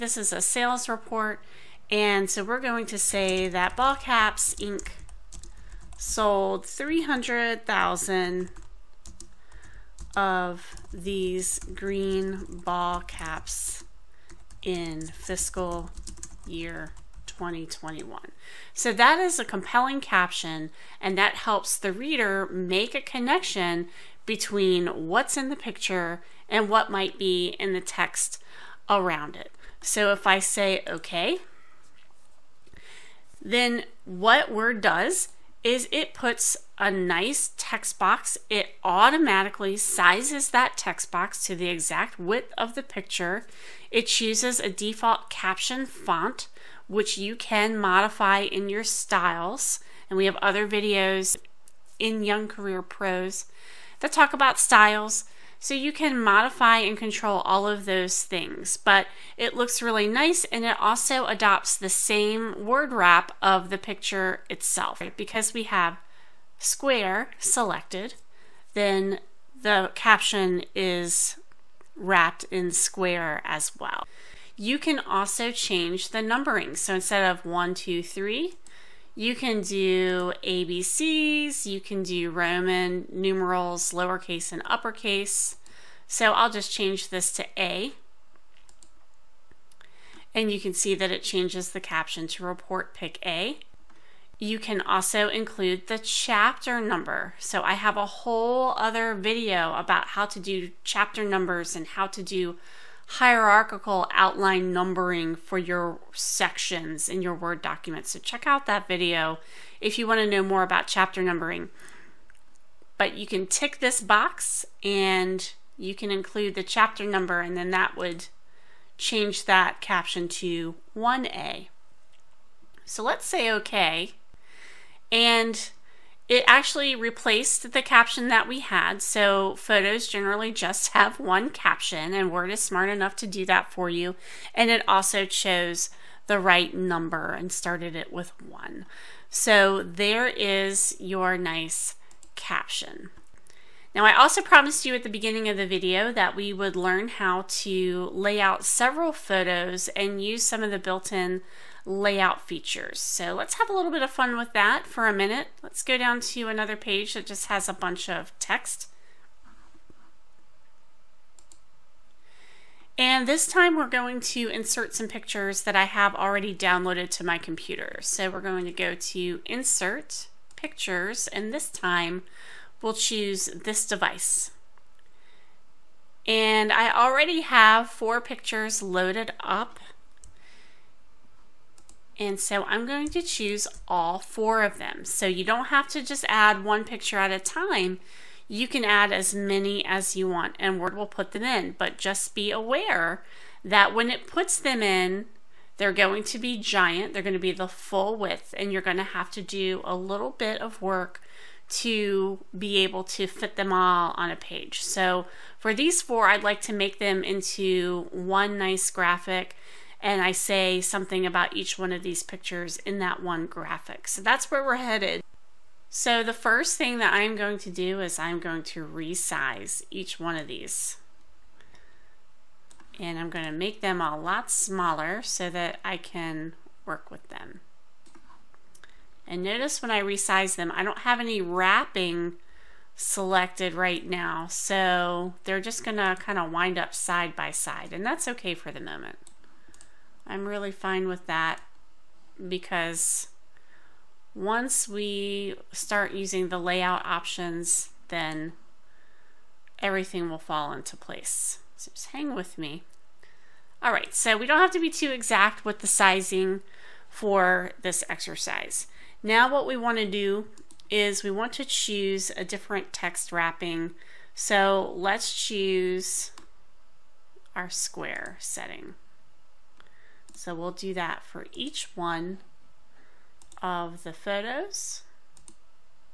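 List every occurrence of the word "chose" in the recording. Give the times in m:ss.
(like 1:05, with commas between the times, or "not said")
2:15.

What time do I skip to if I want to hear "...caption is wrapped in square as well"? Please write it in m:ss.
1:09.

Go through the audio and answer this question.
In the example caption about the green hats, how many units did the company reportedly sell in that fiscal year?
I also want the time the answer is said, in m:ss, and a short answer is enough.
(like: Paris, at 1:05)
300,000, at 0:06.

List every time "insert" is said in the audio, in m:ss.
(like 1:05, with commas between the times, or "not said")
2:44, 2:49.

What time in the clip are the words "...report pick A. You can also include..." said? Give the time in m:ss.
1:32.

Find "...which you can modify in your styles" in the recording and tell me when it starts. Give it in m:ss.
0:46.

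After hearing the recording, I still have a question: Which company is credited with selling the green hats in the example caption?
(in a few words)
Ball Caps Inc.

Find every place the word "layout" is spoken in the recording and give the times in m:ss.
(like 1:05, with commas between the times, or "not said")
2:31, 4:06.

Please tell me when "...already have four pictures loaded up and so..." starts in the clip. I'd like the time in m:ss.
2:56.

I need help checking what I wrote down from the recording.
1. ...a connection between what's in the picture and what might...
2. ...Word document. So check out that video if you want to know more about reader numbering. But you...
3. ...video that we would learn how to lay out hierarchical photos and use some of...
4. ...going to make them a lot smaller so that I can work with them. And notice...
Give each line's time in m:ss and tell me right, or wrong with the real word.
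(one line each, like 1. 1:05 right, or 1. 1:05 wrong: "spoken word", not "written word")
1. 0:22 right
2. 1:47 wrong: "chapter", not "reader"
3. 2:25 wrong: "several", not "hierarchical"
4. 3:43 right.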